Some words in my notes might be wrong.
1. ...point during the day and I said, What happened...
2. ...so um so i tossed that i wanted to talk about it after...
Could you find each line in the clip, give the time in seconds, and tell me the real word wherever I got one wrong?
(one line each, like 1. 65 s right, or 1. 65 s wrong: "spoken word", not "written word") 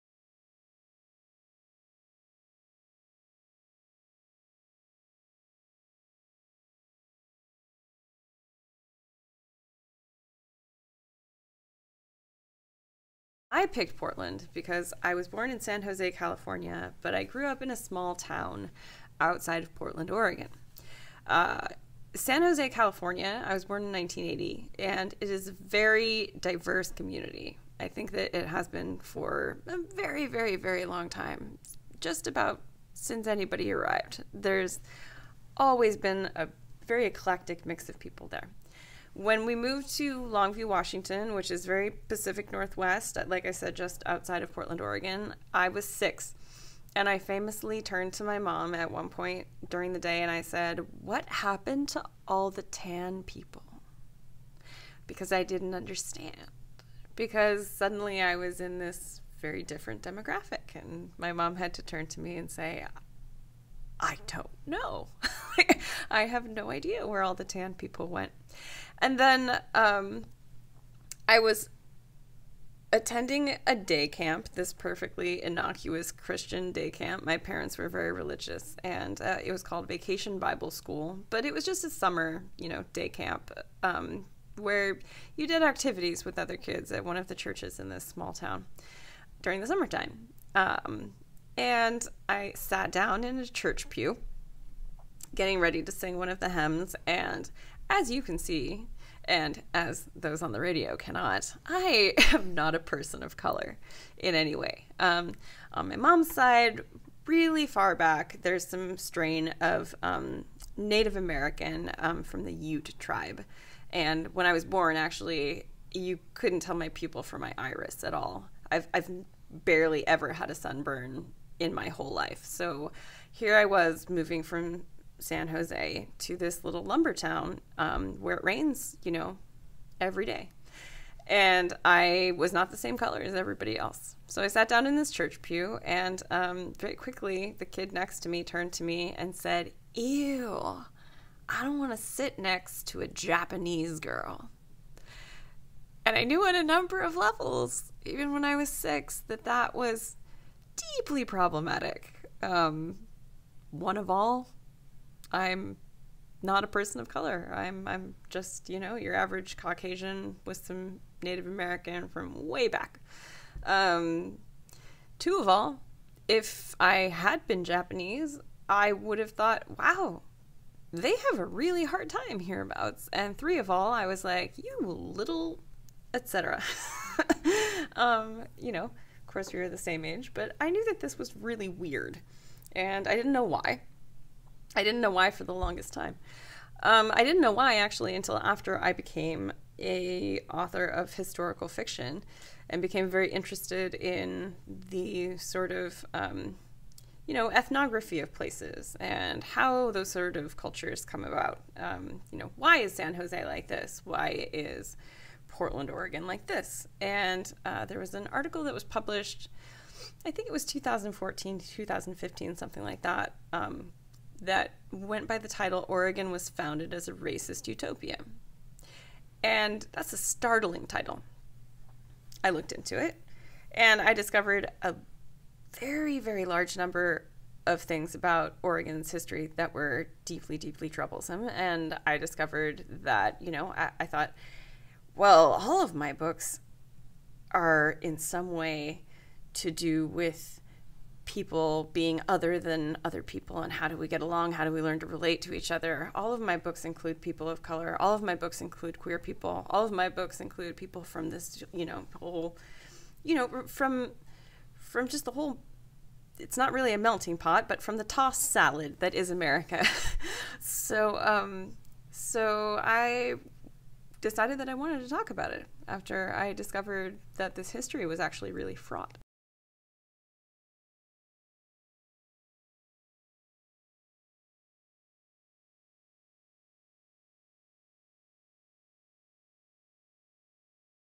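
1. 49 s right
2. 260 s wrong: "decided", not "tossed".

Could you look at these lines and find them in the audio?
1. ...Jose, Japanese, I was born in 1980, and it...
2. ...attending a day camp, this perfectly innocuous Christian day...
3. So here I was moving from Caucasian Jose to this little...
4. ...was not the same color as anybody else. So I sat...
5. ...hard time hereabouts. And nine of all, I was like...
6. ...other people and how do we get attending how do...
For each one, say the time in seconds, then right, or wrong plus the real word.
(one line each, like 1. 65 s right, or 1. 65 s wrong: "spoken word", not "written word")
1. 22 s wrong: "California", not "Japanese"
2. 72 s right
3. 122 s wrong: "San", not "Caucasian"
4. 132 s wrong: "everybody", not "anybody"
5. 171 s wrong: "three", not "nine"
6. 243 s wrong: "along", not "attending".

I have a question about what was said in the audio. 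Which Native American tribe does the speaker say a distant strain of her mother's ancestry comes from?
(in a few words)
Ute.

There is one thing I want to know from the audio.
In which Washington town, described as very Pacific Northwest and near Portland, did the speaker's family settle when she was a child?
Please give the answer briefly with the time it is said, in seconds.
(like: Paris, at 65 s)
Longview, Washington, at 40 s.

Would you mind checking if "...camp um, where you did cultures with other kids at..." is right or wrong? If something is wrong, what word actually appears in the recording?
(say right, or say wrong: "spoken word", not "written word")
wrong: "activities", not "cultures".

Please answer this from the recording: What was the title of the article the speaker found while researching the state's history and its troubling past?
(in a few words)
Oregon Was Founded as a Racist Utopia.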